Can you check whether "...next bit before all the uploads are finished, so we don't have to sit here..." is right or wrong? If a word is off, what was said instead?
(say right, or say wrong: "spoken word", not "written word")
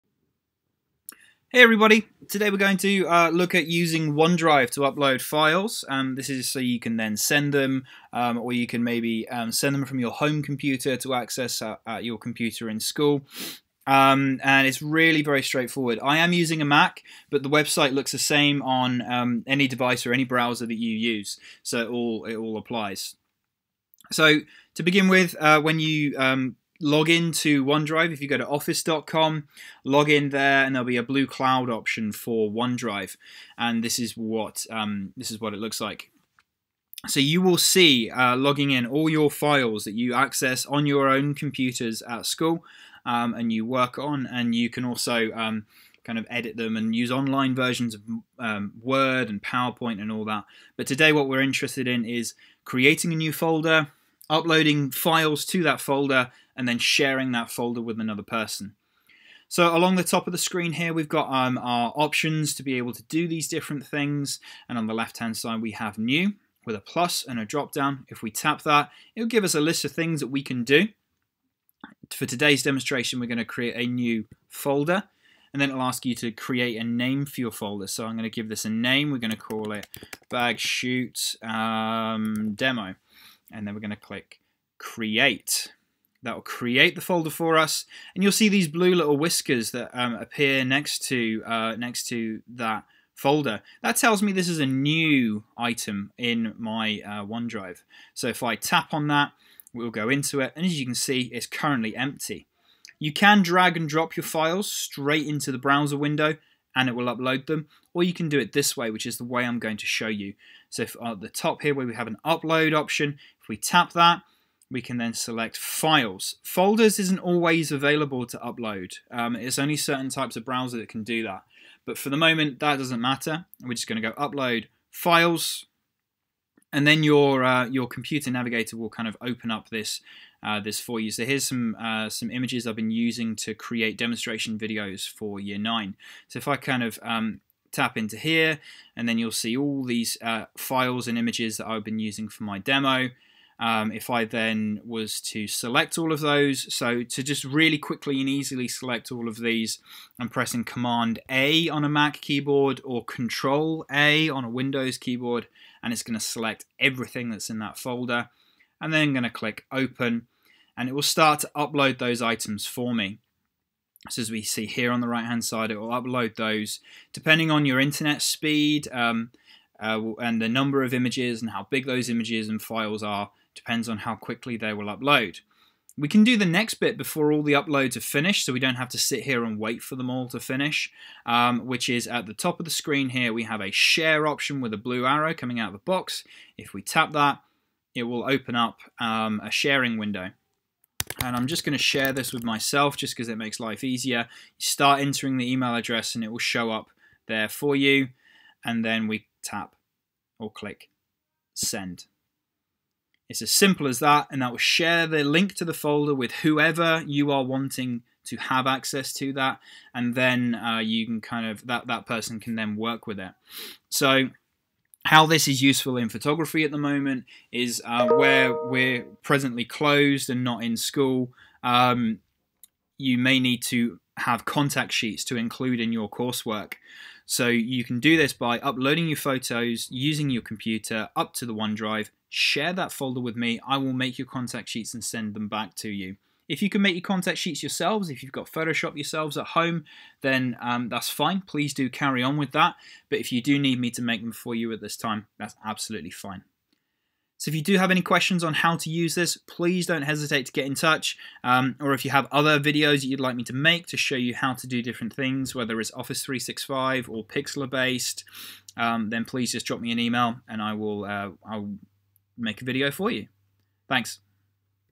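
right.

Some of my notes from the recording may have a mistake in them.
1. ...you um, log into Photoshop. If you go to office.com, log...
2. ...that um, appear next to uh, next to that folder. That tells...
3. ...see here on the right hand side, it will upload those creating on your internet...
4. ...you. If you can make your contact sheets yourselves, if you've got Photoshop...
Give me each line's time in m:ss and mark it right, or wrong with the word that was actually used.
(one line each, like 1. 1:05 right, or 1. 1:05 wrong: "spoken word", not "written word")
1. 0:25 wrong: "OneDrive", not "Photoshop"
2. 1:29 right
3. 2:44 wrong: "depending", not "creating"
4. 3:55 right.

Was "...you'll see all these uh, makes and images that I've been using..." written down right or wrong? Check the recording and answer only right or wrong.
wrong.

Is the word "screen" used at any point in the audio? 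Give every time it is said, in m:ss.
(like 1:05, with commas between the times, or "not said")
1:00, 3:02.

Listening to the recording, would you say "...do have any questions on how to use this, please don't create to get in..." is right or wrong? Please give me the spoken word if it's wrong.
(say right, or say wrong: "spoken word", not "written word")
wrong: "hesitate", not "create".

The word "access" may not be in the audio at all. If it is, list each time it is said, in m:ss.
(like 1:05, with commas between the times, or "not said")
0:11, 0:40, 3:28.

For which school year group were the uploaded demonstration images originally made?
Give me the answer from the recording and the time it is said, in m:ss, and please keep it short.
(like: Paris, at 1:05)
year nine, at 2:15.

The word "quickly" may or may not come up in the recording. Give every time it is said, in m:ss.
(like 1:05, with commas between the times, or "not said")
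2:27, 2:54.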